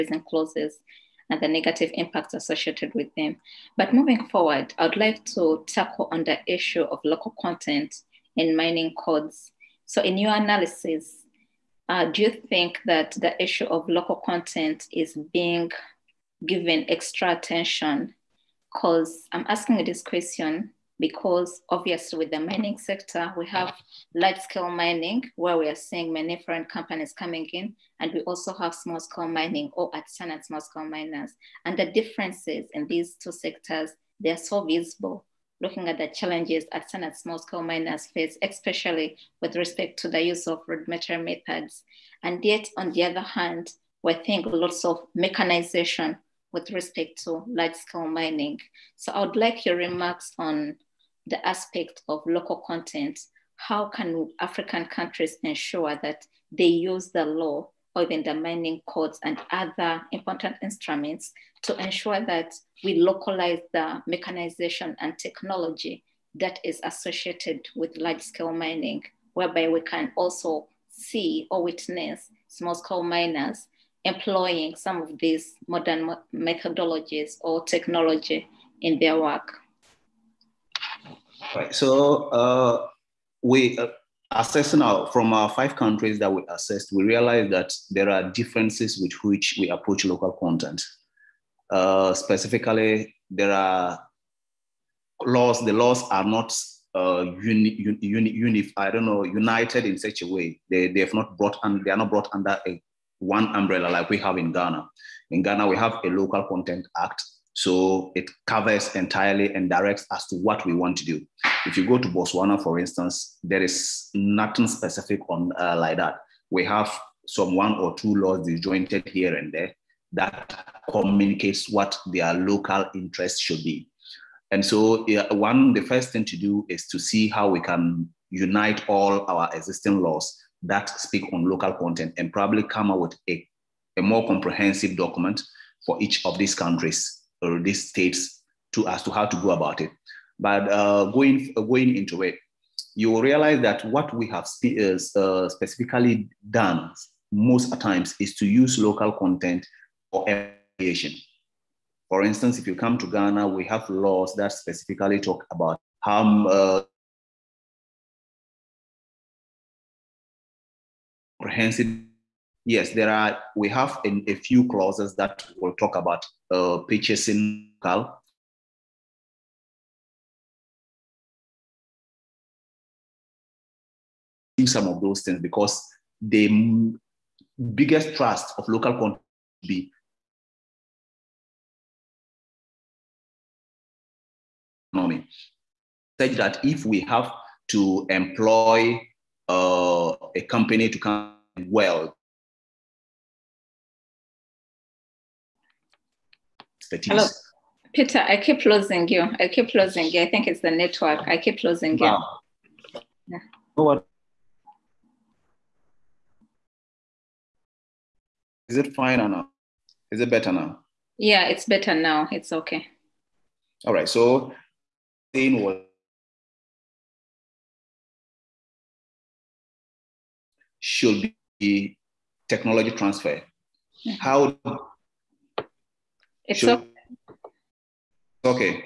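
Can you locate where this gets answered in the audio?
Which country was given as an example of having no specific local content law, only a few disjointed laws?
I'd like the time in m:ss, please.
1:52.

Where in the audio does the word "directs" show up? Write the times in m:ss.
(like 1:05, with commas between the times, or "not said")
1:49.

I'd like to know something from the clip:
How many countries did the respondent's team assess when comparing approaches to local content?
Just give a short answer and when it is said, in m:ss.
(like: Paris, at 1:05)
5, at 1:25.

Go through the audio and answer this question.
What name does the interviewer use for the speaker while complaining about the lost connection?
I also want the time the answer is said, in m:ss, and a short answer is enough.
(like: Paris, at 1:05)
Peter, at 3:17.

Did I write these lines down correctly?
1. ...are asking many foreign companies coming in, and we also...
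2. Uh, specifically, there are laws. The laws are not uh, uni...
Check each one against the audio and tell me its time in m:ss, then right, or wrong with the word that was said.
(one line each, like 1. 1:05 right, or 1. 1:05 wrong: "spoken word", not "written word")
1. 0:25 wrong: "seeing", not "asking"
2. 1:31 right.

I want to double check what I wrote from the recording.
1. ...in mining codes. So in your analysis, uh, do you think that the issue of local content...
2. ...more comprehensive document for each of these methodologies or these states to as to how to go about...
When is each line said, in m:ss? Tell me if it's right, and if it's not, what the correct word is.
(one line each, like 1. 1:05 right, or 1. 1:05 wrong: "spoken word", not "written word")
1. 0:08 right
2. 2:14 wrong: "countries", not "methodologies".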